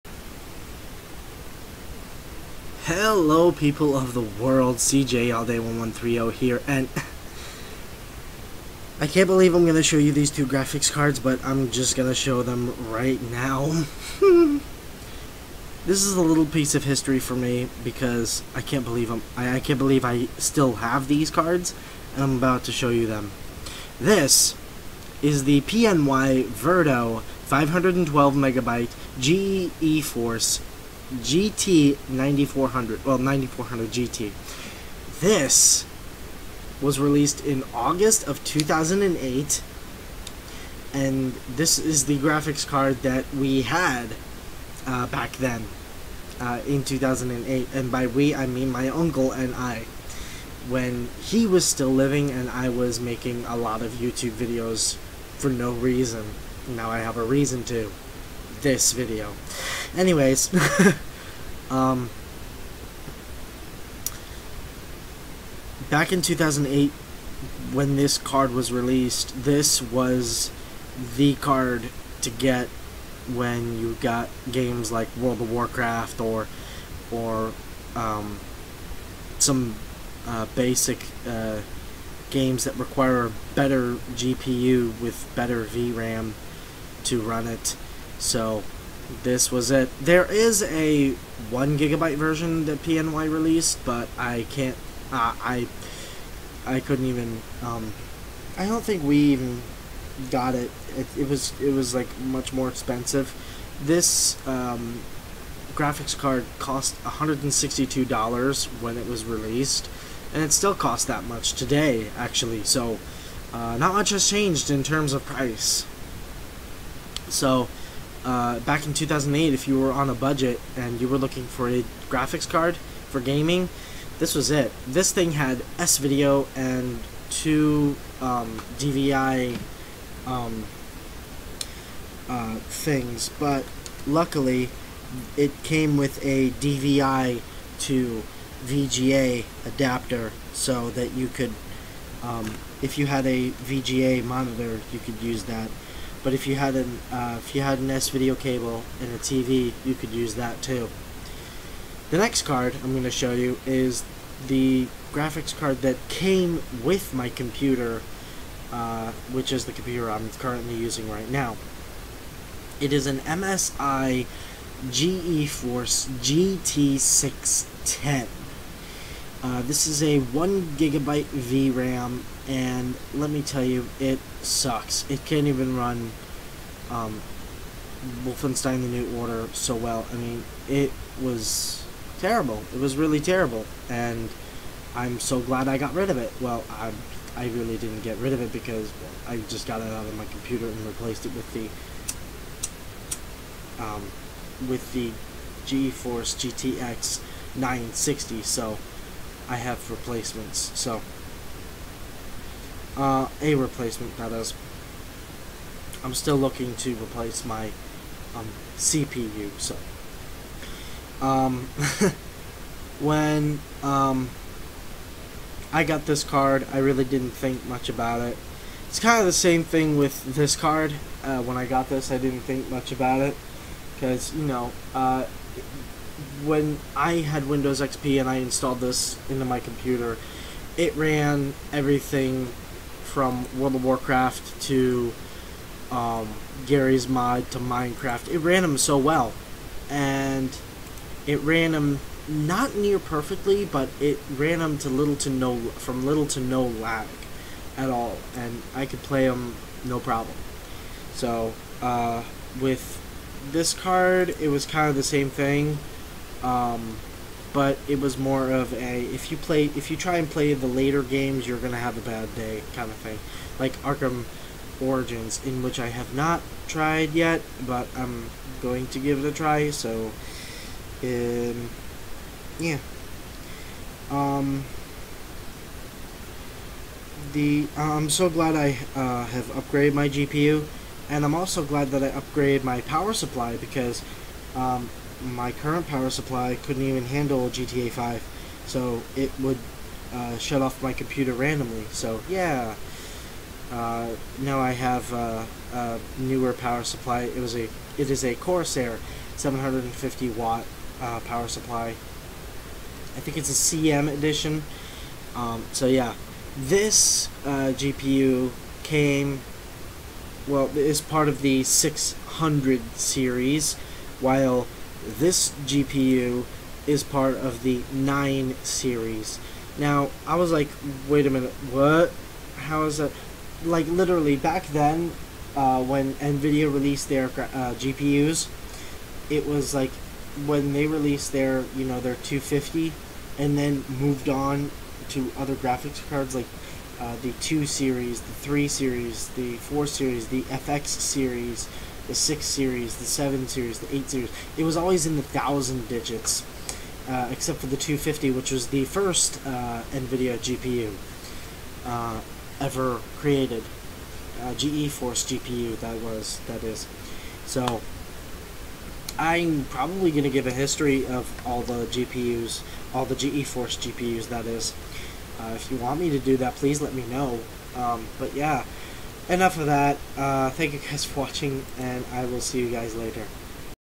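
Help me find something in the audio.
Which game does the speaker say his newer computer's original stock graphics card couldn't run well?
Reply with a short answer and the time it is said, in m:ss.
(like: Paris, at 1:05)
Wolfenstein The New Order, at 2:58.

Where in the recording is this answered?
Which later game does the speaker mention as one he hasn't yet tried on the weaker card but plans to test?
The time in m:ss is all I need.
4:23.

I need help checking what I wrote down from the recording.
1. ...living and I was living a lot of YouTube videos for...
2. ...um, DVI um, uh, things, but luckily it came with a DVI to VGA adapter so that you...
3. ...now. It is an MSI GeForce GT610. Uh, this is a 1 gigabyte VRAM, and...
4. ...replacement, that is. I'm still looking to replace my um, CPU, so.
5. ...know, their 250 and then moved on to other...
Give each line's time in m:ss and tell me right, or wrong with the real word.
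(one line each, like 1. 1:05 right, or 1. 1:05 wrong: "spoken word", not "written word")
1. 0:51 wrong: "making", not "living"
2. 2:08 right
3. 2:41 right
4. 3:23 right
5. 5:31 right.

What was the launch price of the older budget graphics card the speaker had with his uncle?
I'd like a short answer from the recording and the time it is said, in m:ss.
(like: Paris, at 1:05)
$162, at 1:47.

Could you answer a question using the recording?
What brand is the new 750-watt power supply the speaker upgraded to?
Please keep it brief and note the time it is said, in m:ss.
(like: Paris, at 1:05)
Corsair, at 4:58.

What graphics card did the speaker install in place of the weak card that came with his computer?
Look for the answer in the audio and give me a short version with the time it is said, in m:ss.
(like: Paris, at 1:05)
GeForce GTX 960, at 3:15.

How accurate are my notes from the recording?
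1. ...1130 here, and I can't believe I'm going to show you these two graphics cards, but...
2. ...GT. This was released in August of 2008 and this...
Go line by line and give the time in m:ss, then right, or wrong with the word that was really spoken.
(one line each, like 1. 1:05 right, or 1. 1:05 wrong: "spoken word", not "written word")
1. 0:05 right
2. 0:33 right.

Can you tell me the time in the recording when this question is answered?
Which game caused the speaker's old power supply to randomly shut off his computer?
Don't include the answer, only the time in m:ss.
4:47.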